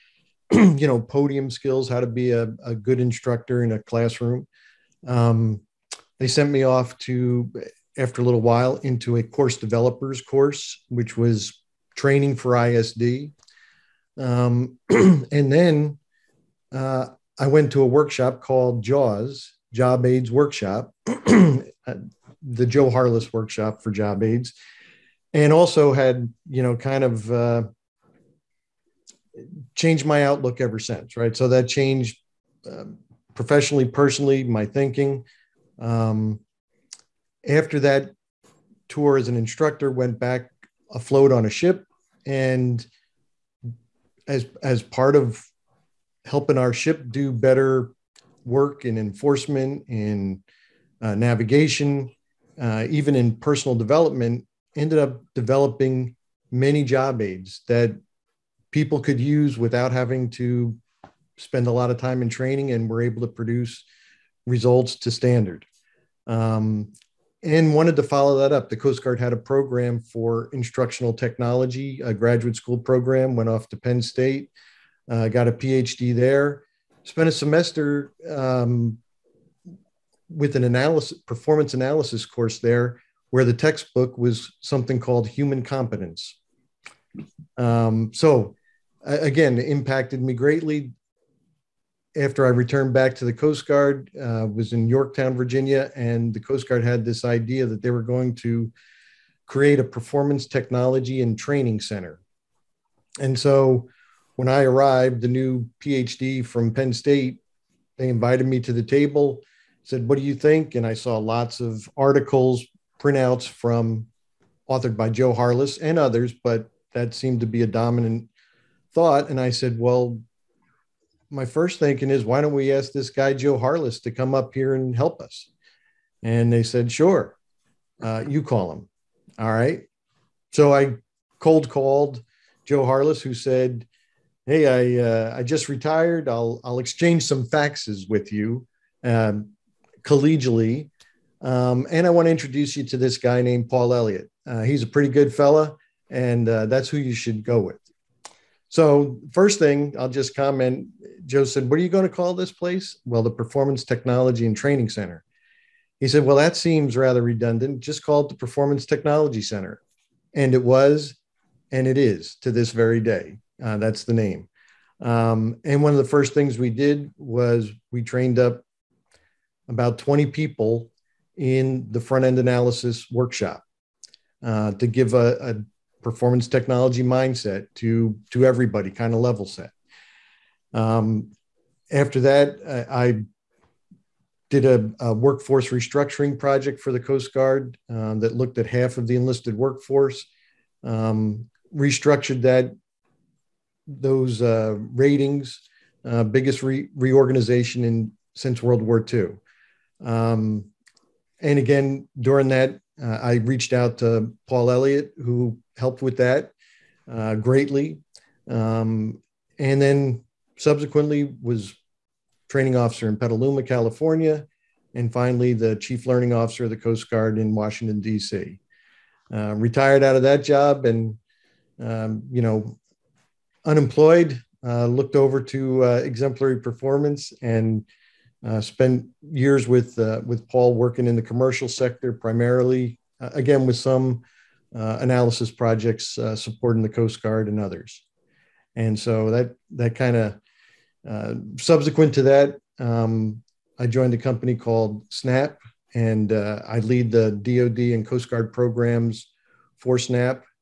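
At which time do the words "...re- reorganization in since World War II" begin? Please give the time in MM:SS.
03:16.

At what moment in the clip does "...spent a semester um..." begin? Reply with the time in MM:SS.
01:17.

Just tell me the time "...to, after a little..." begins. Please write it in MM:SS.
00:06.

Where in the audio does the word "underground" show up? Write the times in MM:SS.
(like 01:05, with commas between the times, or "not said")
not said.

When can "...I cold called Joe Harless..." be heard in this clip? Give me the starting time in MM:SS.
02:10.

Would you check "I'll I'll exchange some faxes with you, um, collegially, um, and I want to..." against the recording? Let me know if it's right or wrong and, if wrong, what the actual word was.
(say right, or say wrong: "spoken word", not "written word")
right.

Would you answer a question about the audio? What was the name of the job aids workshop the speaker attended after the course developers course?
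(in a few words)
JAWS.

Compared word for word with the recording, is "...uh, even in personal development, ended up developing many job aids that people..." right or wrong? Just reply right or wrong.
right.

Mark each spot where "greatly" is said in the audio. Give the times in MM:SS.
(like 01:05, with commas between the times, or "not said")
01:30, 03:27.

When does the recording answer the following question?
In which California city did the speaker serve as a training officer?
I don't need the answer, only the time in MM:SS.
03:33.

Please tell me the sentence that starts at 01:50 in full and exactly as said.
And I saw lots of articles, printouts from authored by Joe Harless and others, but that seemed to be a dominant thought.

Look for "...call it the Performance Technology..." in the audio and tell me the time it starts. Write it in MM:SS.
02:38.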